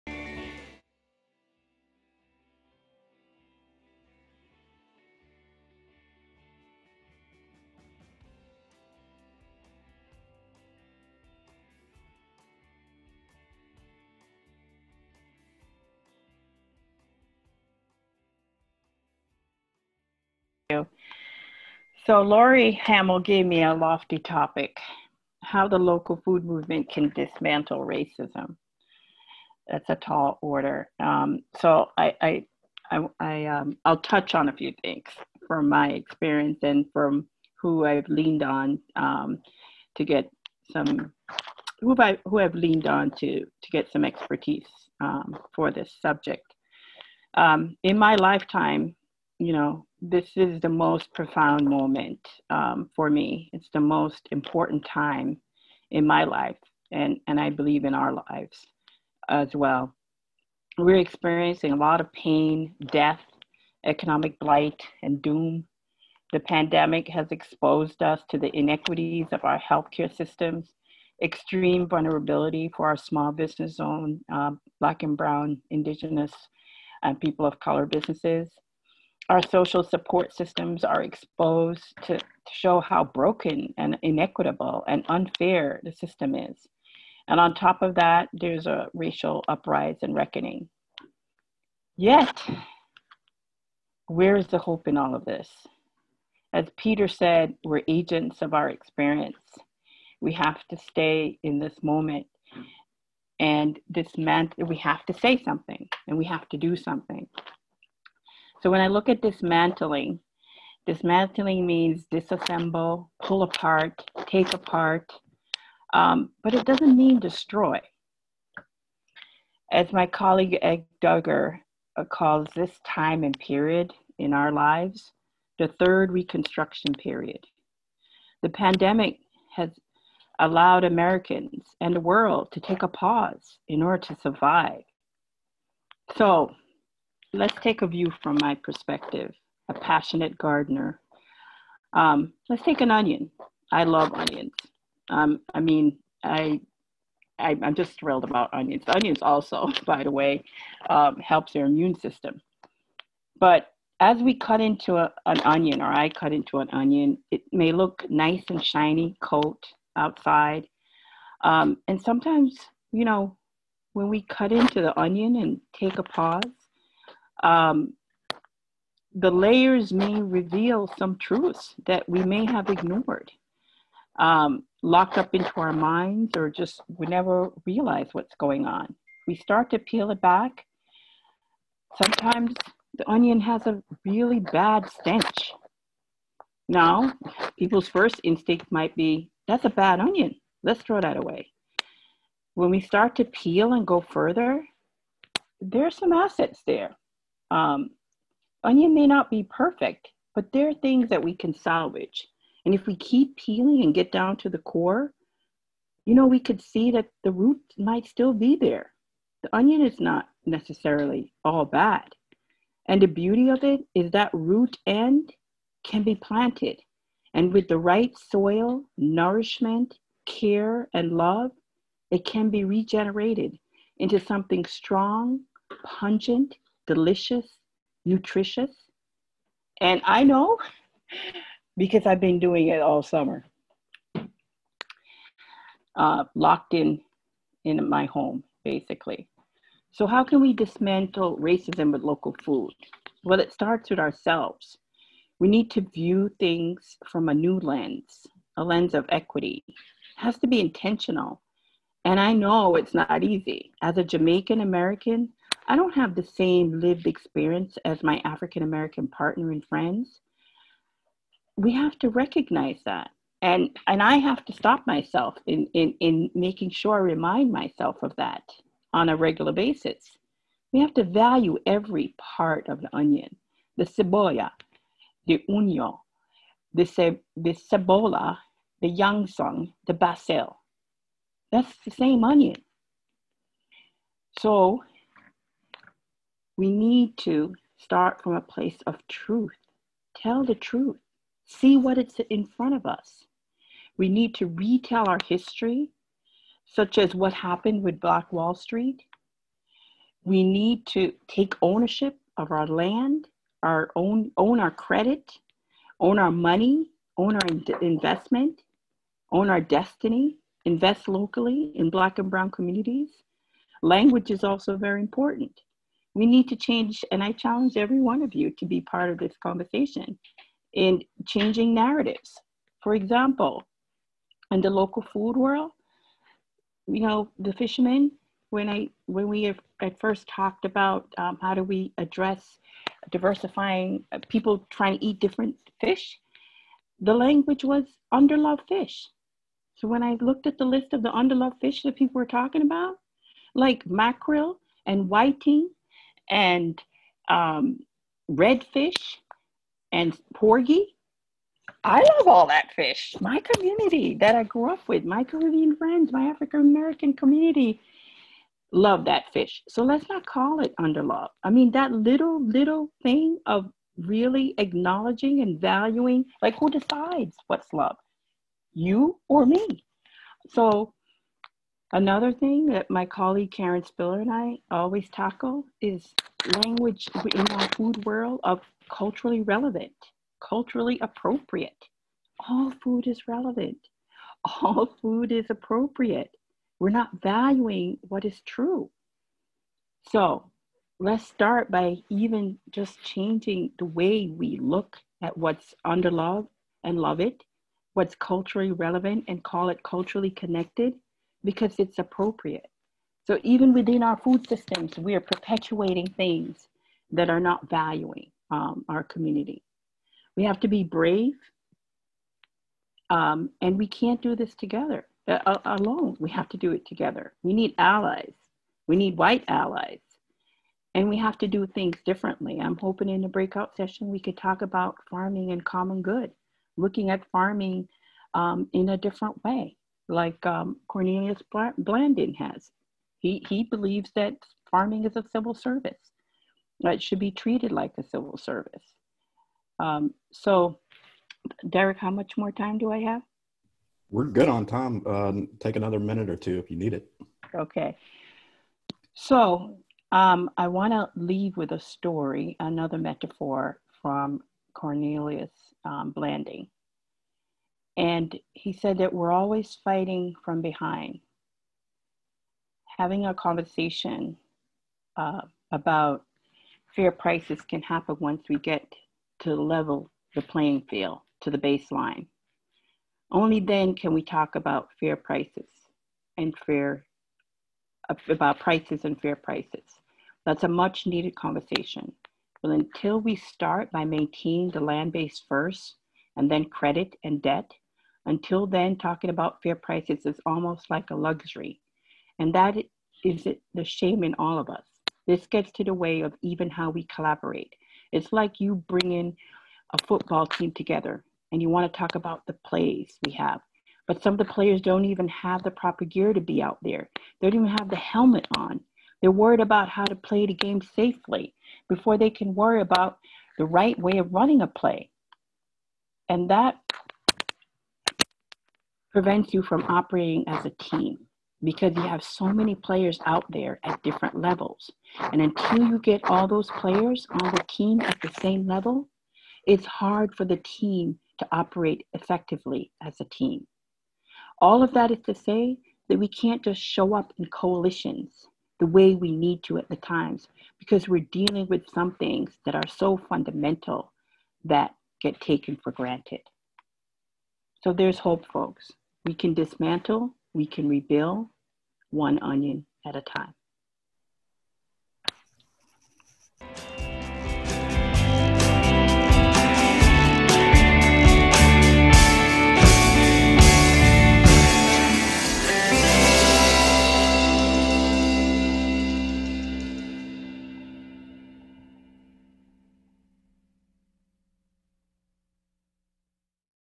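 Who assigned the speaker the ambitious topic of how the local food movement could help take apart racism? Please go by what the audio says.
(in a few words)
Laurie Hamill.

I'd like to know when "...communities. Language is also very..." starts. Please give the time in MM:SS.
05:12.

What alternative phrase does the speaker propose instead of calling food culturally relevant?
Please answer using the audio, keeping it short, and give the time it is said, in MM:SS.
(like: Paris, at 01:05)
culturally connected, at 06:39.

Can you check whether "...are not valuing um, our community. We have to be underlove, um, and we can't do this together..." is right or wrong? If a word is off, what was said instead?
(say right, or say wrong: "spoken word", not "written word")
wrong: "brave", not "underlove".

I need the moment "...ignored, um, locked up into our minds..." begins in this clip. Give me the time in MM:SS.
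02:52.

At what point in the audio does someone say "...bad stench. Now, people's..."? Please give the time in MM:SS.
03:04.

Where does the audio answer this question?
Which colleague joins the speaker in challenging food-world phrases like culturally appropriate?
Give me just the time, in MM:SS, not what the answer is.
06:13.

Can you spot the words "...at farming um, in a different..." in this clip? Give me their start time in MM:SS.
07:07.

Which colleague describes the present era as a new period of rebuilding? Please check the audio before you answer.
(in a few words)
Ed Duggar.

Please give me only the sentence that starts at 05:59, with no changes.
So let's not call it underlove.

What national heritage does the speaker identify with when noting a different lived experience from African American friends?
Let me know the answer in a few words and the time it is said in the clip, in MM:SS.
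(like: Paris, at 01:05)
Jamaican American, at 04:14.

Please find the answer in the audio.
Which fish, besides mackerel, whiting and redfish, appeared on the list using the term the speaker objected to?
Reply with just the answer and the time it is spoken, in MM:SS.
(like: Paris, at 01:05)
porgy, at 05:50.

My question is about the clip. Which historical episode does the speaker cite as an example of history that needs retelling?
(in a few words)
Black Wall Street.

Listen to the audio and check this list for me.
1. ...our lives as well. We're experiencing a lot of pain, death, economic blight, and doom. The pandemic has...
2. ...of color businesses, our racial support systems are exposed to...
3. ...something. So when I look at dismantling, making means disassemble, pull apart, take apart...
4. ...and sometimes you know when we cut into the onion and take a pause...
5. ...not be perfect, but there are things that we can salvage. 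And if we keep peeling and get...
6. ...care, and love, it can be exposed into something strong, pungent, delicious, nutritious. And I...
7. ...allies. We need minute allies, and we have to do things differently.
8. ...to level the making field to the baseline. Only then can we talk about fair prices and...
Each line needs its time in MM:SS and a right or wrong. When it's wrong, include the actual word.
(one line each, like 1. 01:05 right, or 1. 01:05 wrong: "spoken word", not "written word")
1. 00:57 right
2. 01:17 wrong: "social", not "racial"
3. 01:46 wrong: "dismantling", not "making"
4. 02:41 right
5. 03:19 right
6. 03:40 wrong: "regenerated", not "exposed"
7. 06:57 wrong: "white", not "minute"
8. 07:49 wrong: "playing", not "making".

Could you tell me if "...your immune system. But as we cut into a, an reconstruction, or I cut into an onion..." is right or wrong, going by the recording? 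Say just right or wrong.
wrong.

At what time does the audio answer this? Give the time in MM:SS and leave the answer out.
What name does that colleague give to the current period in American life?
02:05.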